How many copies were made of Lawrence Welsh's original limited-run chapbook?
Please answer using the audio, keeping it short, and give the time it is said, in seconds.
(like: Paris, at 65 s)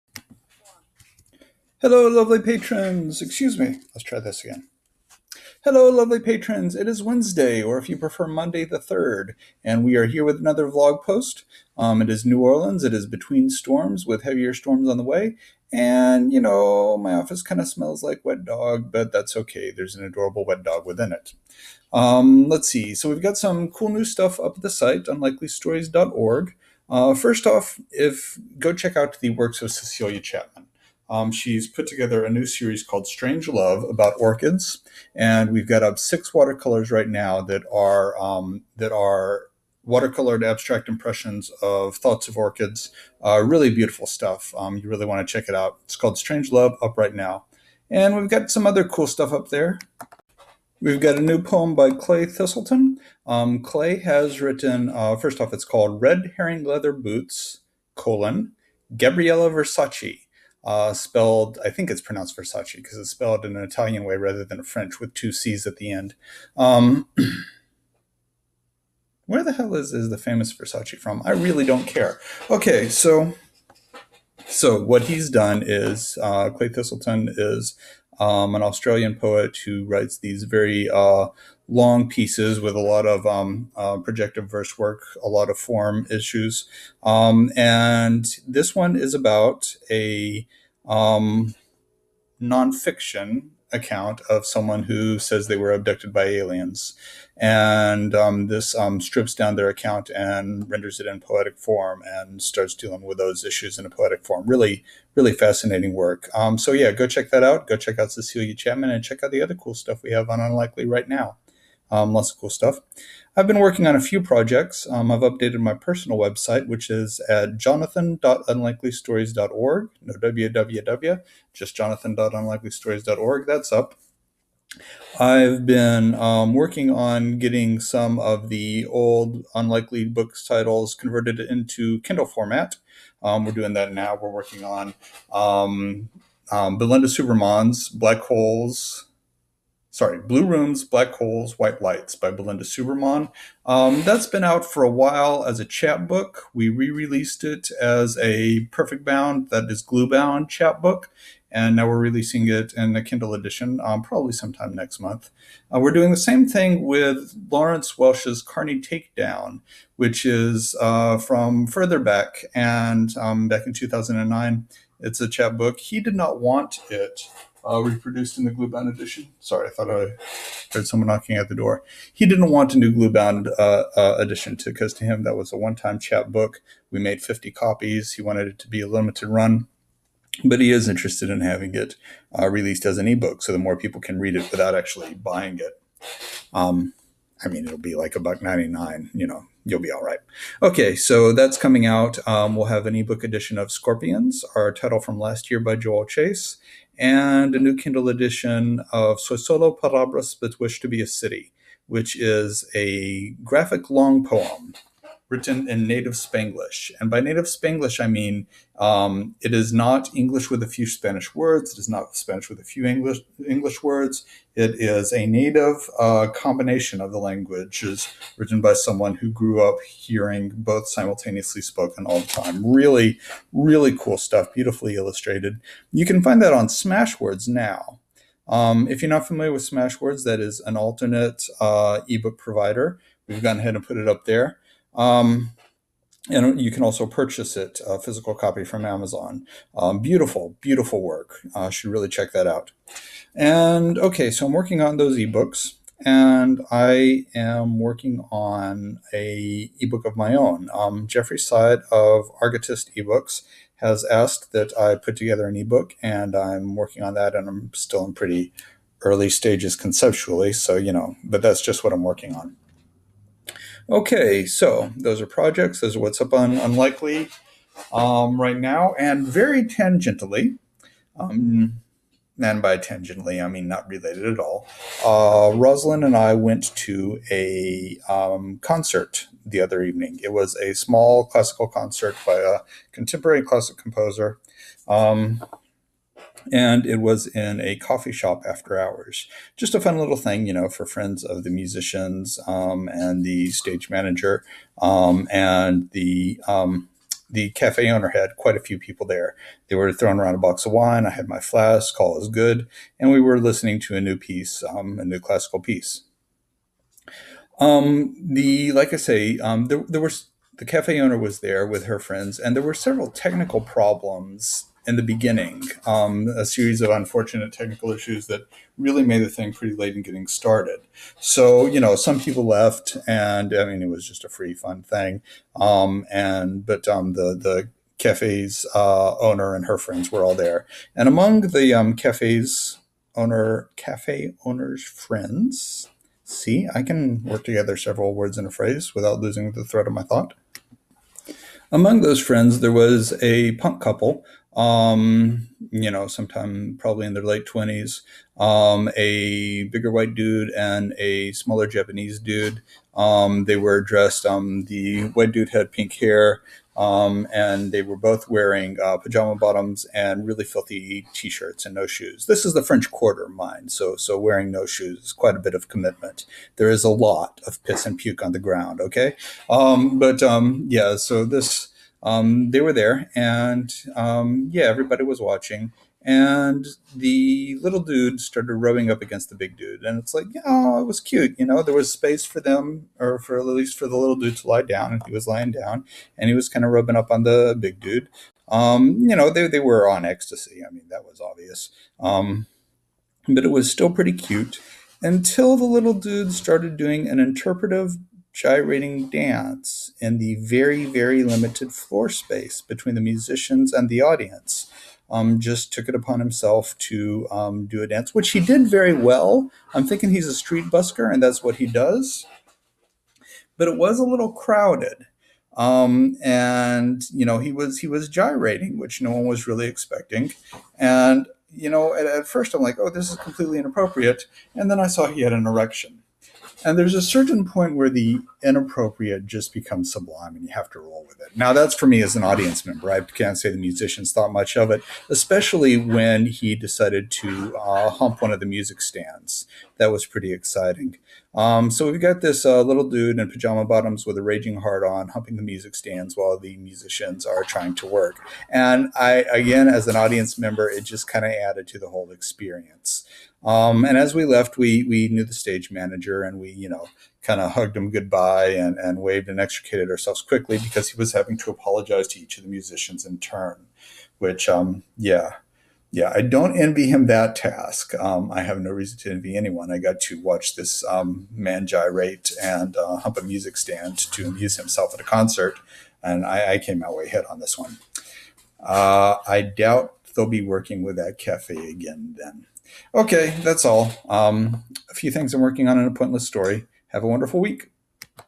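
50, at 177 s.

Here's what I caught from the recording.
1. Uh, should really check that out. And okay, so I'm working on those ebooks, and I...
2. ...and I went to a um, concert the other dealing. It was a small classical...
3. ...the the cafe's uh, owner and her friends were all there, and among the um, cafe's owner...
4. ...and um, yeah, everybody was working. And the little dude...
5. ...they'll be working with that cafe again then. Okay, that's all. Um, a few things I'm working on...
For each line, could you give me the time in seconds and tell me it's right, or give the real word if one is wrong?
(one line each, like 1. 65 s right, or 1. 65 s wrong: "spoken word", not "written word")
1. 241 s right
2. 276 s wrong: "evening", not "dealing"
3. 327 s right
4. 373 s wrong: "watching", not "working"
5. 480 s right.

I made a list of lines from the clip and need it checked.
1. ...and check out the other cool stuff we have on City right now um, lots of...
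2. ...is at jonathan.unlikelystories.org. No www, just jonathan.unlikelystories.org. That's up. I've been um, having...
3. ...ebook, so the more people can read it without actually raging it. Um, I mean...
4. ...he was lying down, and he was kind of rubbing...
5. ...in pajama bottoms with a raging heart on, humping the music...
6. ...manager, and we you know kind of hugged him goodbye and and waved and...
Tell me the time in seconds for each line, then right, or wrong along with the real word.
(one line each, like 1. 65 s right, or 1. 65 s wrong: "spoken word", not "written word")
1. 108 s wrong: "Unlikely", not "City"
2. 116 s wrong: "working", not "having"
3. 183 s wrong: "buying", not "raging"
4. 385 s right
5. 443 s right
6. 455 s right.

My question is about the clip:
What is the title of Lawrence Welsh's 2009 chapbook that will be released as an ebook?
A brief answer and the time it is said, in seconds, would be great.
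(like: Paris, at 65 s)
Carney Takedown, at 158 s.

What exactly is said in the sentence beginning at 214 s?
It is a native uh, combination of the languages written by someone who grew up hearing both simultaneously spoken all the time.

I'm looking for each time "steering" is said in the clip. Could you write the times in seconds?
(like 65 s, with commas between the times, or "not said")
not said.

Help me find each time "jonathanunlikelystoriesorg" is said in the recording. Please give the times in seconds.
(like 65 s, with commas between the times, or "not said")
117 s, 121 s.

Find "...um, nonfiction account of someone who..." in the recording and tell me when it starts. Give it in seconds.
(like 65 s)
90 s.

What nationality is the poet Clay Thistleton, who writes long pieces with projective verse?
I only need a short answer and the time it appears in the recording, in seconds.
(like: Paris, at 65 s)
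Australian, at 78 s.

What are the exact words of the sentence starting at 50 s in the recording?
We've got a new poem by Clay Thistleton.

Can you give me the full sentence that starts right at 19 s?
There's an adorable wet dog within it.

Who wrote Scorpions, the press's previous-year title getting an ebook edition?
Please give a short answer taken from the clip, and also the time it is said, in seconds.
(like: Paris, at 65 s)
Joel Chace, at 195 s.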